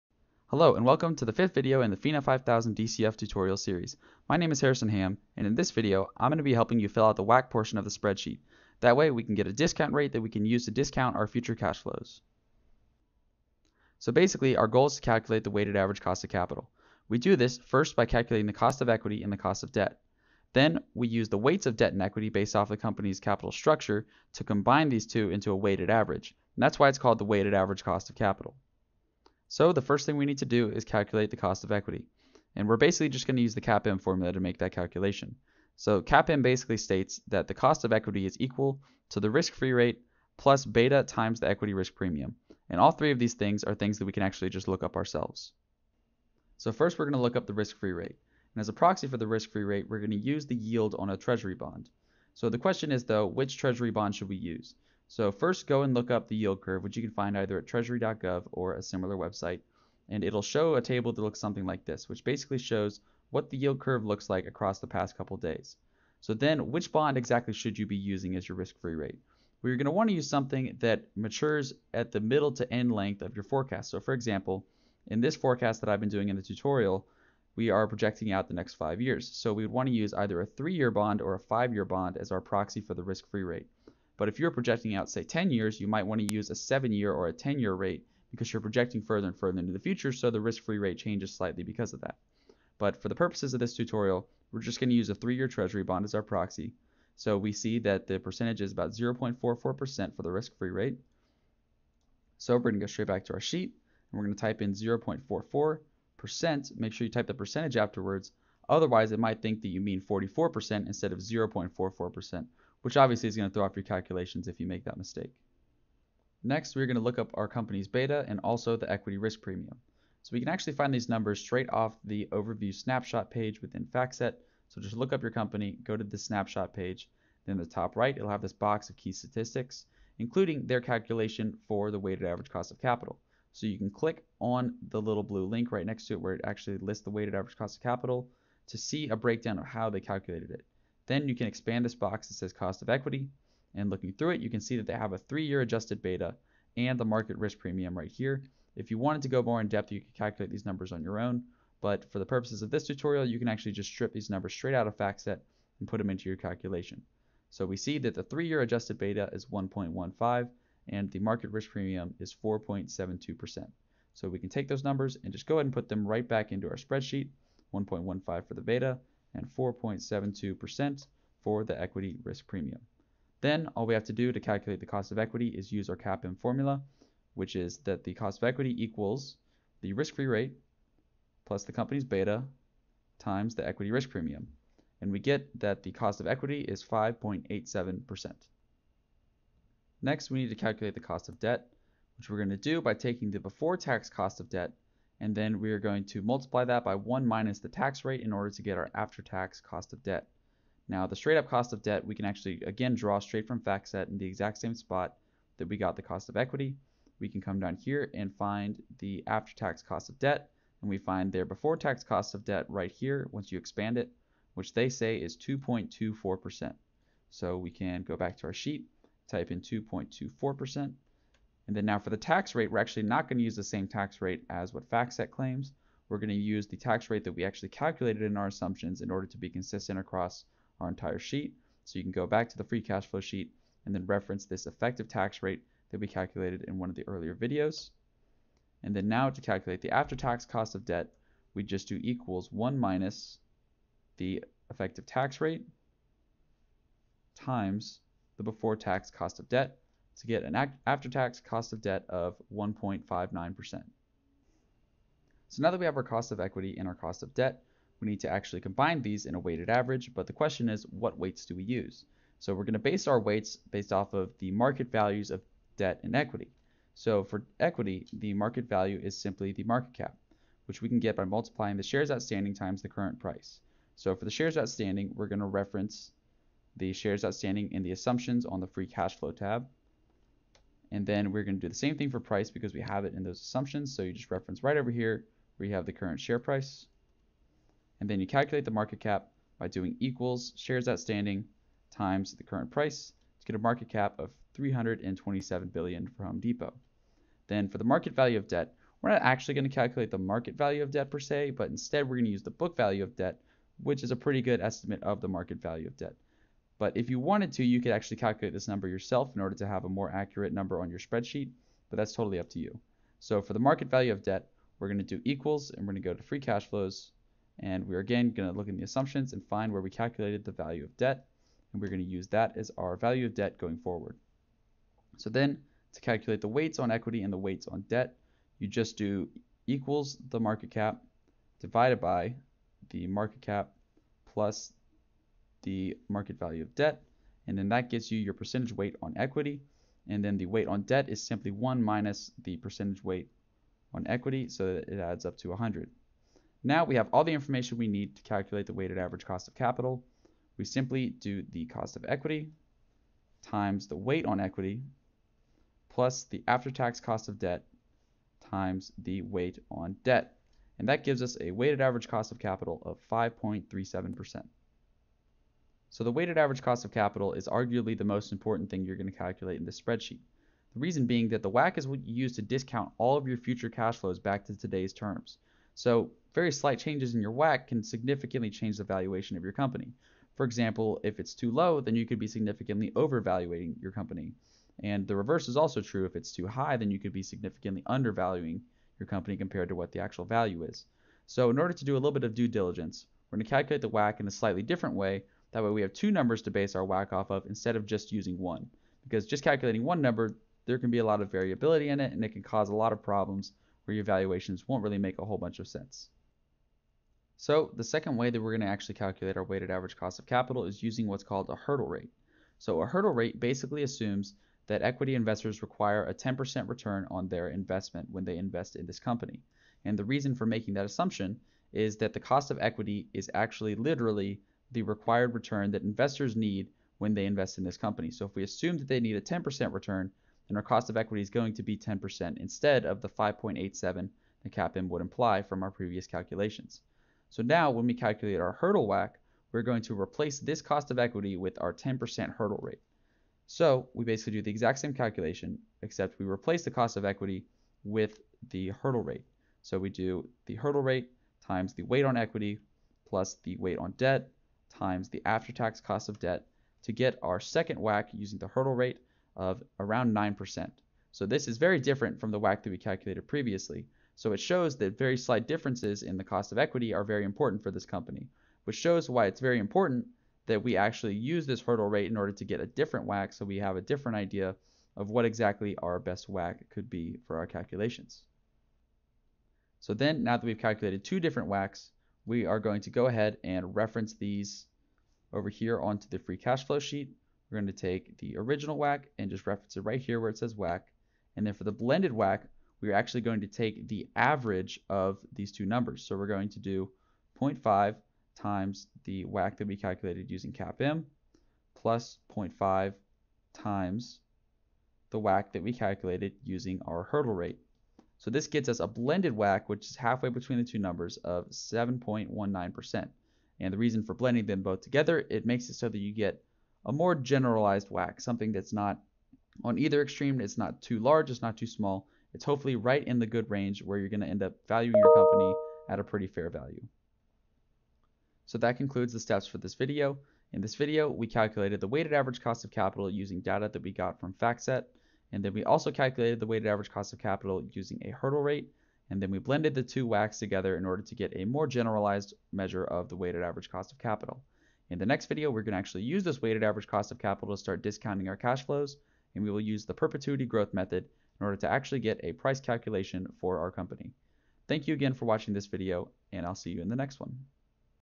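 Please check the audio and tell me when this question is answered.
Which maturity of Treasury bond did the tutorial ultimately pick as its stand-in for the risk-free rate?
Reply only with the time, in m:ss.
1:35.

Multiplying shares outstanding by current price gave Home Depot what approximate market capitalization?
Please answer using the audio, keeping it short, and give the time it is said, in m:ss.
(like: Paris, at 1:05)
327 billion, at 4:54.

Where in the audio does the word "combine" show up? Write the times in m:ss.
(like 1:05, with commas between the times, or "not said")
0:24, 4:18.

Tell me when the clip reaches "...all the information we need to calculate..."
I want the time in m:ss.
5:47.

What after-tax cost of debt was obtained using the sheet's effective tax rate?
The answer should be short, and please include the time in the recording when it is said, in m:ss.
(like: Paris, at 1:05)
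1.59%, at 4:12.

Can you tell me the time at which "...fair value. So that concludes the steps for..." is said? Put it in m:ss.
8:46.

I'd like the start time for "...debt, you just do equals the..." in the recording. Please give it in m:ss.
5:27.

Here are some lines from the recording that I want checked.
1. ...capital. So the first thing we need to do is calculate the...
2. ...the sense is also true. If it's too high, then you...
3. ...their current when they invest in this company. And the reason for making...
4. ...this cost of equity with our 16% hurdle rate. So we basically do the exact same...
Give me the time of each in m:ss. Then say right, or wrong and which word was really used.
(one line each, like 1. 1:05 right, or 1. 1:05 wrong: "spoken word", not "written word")
1. 0:28 right
2. 6:25 wrong: "reverse", not "sense"
3. 6:57 wrong: "investment", not "current"
4. 7:20 wrong: "10", not "16".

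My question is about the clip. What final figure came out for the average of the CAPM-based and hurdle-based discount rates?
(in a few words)
7.19%.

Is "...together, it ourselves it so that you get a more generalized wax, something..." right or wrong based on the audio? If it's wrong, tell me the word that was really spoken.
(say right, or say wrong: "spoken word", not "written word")
wrong: "makes", not "ourselves".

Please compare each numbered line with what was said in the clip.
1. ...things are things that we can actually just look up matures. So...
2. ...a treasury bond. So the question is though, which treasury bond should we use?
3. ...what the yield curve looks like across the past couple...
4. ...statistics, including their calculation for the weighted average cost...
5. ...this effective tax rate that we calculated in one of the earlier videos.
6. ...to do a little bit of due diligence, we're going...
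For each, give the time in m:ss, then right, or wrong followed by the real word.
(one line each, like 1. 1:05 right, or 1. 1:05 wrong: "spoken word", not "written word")
1. 0:43 wrong: "ourselves", not "matures"
2. 0:51 right
3. 1:03 right
4. 2:09 right
5. 3:54 right
6. 6:31 right.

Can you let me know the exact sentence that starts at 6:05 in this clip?
So the weighted average cost of capital is arguably the most important thing you're going to calculate in this spreadsheet.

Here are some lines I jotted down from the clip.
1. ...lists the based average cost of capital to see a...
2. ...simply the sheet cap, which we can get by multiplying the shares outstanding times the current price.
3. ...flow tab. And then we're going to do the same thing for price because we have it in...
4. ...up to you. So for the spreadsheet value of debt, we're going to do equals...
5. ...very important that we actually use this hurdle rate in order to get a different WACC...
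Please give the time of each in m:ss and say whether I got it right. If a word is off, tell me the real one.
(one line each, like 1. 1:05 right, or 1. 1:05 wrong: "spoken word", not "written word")
1. 2:16 wrong: "weighted", not "based"
2. 4:29 wrong: "market", not "sheet"
3. 4:39 right
4. 5:12 wrong: "market", not "spreadsheet"
5. 7:49 right.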